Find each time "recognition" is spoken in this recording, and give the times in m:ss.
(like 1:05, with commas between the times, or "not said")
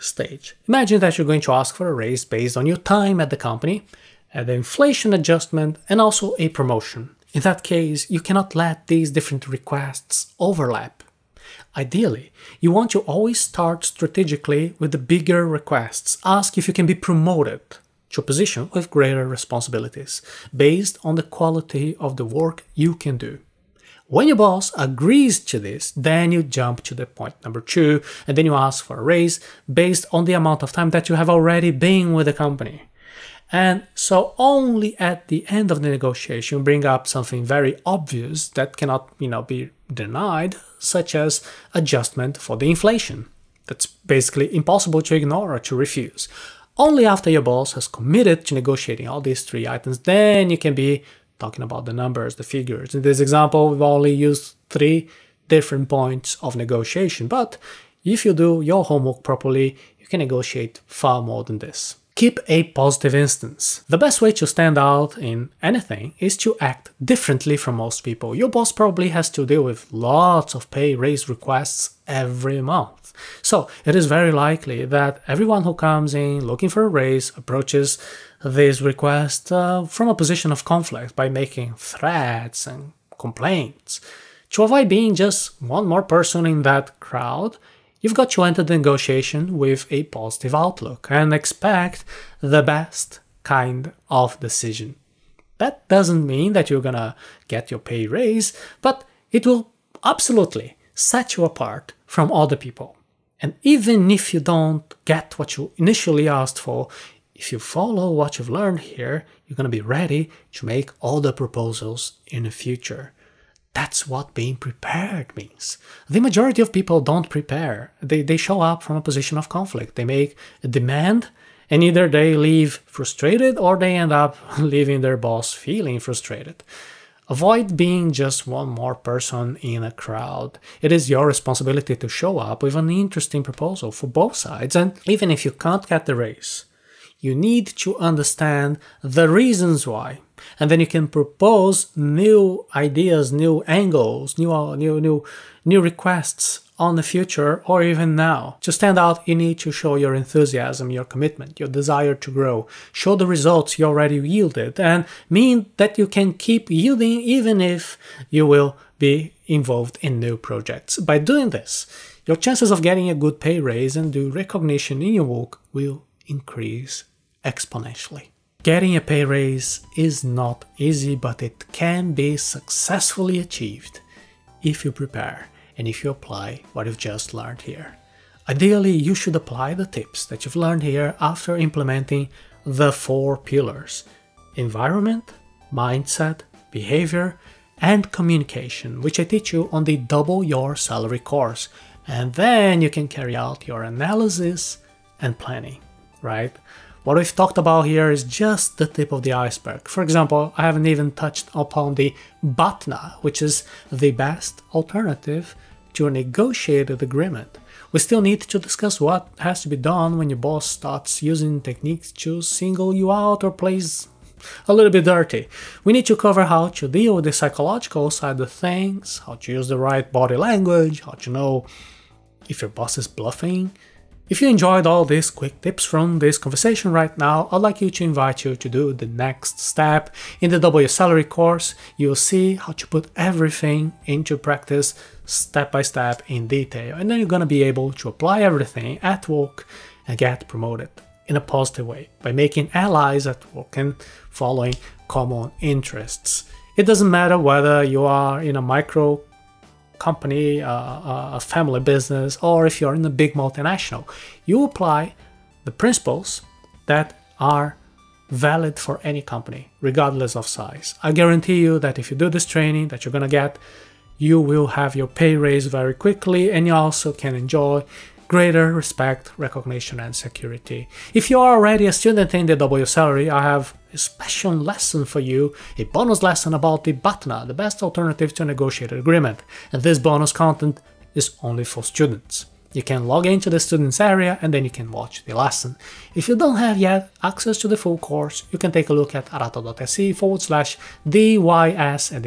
2:44, 4:29.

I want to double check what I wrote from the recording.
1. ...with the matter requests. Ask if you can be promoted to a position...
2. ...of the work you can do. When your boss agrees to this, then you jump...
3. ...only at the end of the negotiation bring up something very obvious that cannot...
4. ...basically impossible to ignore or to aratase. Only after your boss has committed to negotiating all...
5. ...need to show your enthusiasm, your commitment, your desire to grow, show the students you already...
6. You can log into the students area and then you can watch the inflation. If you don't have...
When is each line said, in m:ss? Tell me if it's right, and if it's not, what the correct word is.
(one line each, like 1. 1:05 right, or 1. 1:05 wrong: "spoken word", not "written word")
1. 0:14 wrong: "bigger", not "matter"
2. 0:21 right
3. 0:34 right
4. 0:43 wrong: "refuse", not "aratase"
5. 2:29 wrong: "results", not "students"
6. 4:42 wrong: "lesson", not "inflation".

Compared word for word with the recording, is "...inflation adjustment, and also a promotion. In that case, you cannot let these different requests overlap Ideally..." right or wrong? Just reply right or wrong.
right.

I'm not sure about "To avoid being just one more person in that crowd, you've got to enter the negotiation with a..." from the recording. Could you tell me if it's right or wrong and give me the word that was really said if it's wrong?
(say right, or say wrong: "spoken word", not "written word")
right.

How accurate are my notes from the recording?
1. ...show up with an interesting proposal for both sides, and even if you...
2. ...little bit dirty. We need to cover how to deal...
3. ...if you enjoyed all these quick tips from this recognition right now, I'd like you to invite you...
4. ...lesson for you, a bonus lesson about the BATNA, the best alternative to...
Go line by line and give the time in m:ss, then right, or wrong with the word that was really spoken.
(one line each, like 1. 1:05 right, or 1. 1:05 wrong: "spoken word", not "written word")
1. 2:12 right
2. 3:34 right
3. 3:44 wrong: "conversation", not "recognition"
4. 4:34 right.